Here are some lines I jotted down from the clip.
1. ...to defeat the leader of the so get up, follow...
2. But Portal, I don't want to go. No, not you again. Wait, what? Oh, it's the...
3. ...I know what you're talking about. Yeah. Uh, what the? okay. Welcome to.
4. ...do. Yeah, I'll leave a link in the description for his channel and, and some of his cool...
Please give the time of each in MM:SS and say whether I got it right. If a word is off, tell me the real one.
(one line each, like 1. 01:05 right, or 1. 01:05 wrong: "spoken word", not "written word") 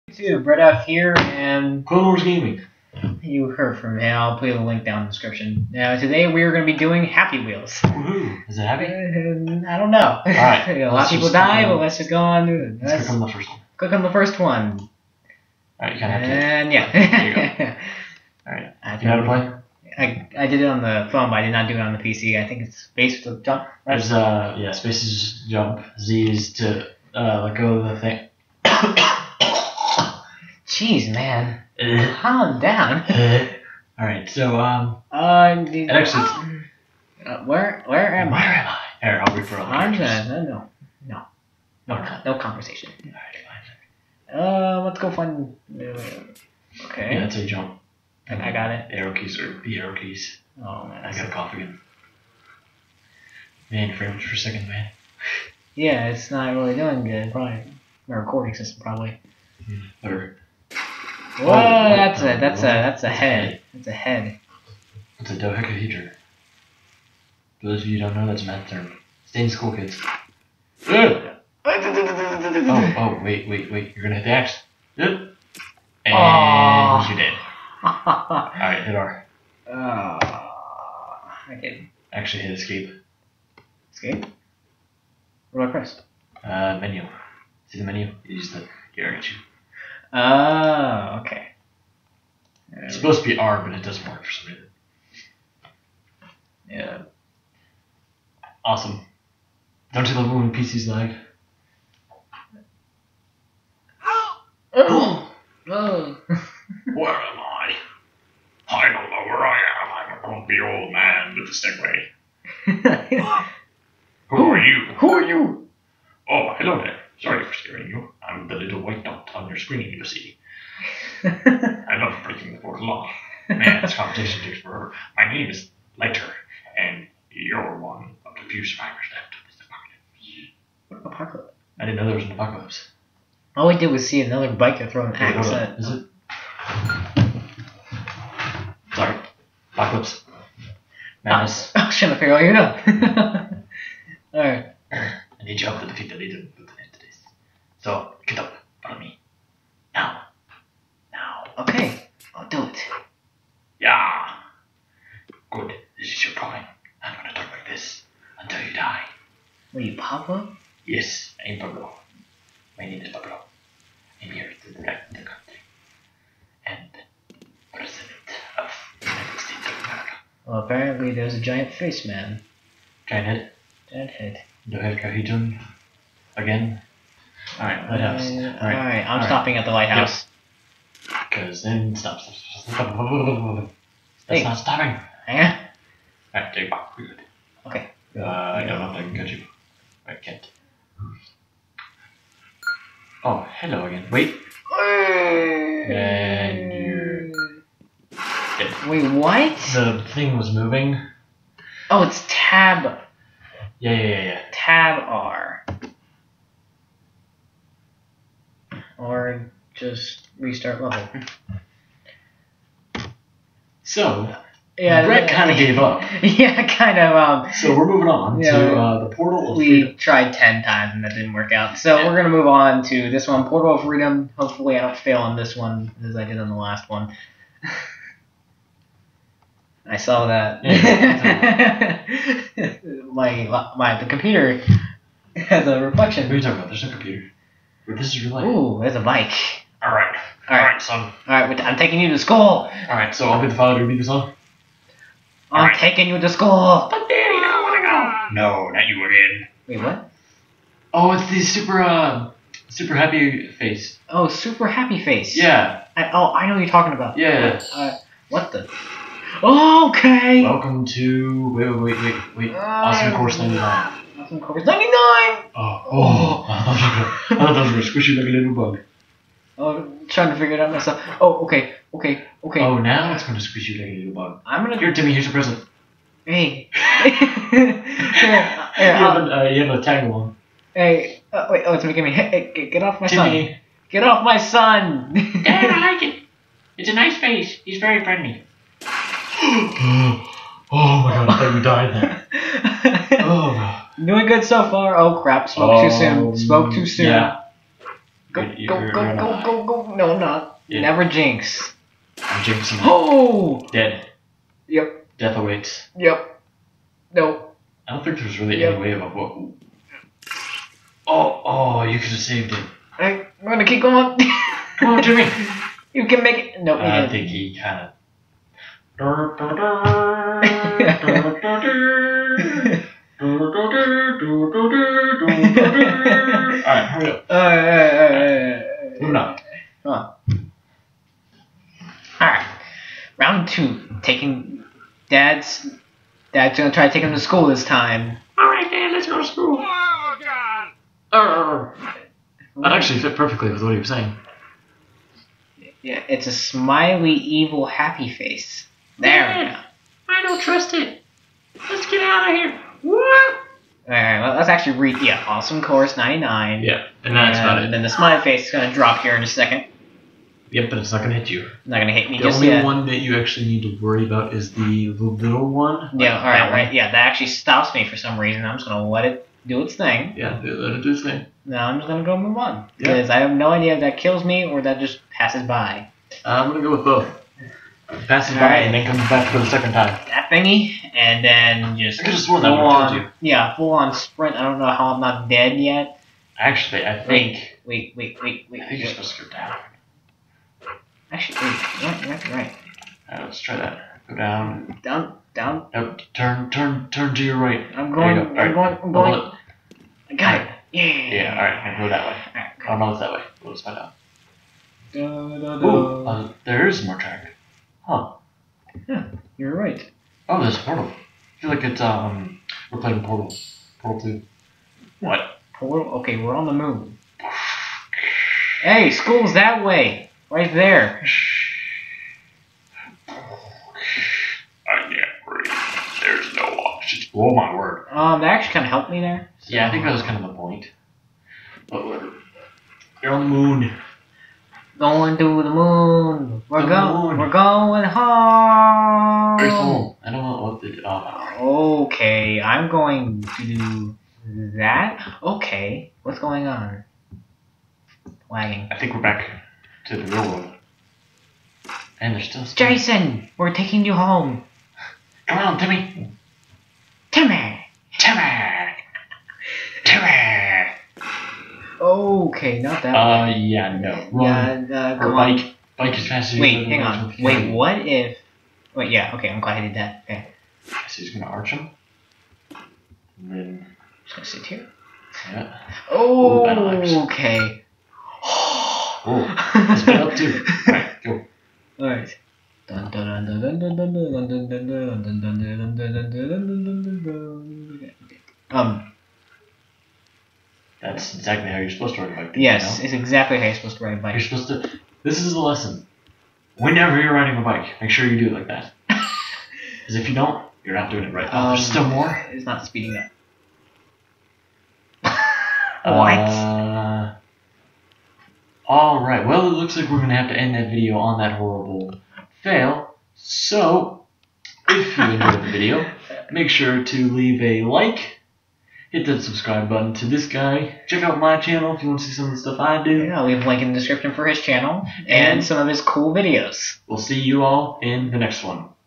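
1. 02:25 right
2. 04:06 wrong: "Daddy", not "Portal"
3. 04:16 right
4. 08:42 right.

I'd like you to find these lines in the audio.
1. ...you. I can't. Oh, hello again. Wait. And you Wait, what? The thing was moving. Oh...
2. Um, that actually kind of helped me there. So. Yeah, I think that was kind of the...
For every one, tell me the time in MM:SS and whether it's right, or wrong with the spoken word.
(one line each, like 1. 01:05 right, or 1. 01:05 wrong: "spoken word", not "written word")
1. 03:09 right
2. 07:07 right.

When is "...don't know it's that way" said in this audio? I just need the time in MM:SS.
06:42.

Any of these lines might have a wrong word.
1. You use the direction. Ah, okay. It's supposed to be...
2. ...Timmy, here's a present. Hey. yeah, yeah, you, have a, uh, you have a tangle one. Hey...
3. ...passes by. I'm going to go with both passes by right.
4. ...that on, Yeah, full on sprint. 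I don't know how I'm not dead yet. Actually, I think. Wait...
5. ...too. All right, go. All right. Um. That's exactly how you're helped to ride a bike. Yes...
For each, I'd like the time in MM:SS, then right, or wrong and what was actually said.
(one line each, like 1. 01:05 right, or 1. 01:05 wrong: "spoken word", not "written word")
1. 01:28 right
2. 04:34 right
3. 06:15 right
4. 06:22 right
5. 08:00 wrong: "supposed", not "helped".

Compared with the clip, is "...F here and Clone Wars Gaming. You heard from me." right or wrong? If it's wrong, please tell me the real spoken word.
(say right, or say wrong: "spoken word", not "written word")
right.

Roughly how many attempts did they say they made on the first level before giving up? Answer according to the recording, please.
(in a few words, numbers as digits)
10.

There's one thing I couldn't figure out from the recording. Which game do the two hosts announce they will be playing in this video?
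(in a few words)
Happy Wheels.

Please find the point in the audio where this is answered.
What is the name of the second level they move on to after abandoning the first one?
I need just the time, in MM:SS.
03:43.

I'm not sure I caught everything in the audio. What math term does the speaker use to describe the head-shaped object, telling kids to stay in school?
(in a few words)
dodecahedron.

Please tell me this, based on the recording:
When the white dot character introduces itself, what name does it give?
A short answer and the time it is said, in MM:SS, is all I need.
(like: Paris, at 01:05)
Lighter, at 02:05.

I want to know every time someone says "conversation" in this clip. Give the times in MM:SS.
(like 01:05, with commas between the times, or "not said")
00:42.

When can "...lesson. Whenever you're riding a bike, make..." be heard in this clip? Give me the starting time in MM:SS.
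08:15.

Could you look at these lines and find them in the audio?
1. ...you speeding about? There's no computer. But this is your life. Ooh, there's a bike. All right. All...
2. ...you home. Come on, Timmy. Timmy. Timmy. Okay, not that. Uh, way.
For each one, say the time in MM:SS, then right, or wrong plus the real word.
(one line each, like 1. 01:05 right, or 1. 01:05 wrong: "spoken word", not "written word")
1. 03:56 wrong: "talking", not "speeding"
2. 07:33 right.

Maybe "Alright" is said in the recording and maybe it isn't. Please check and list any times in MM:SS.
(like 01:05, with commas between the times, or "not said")
01:17, 02:24, 05:23, 05:32, 05:38.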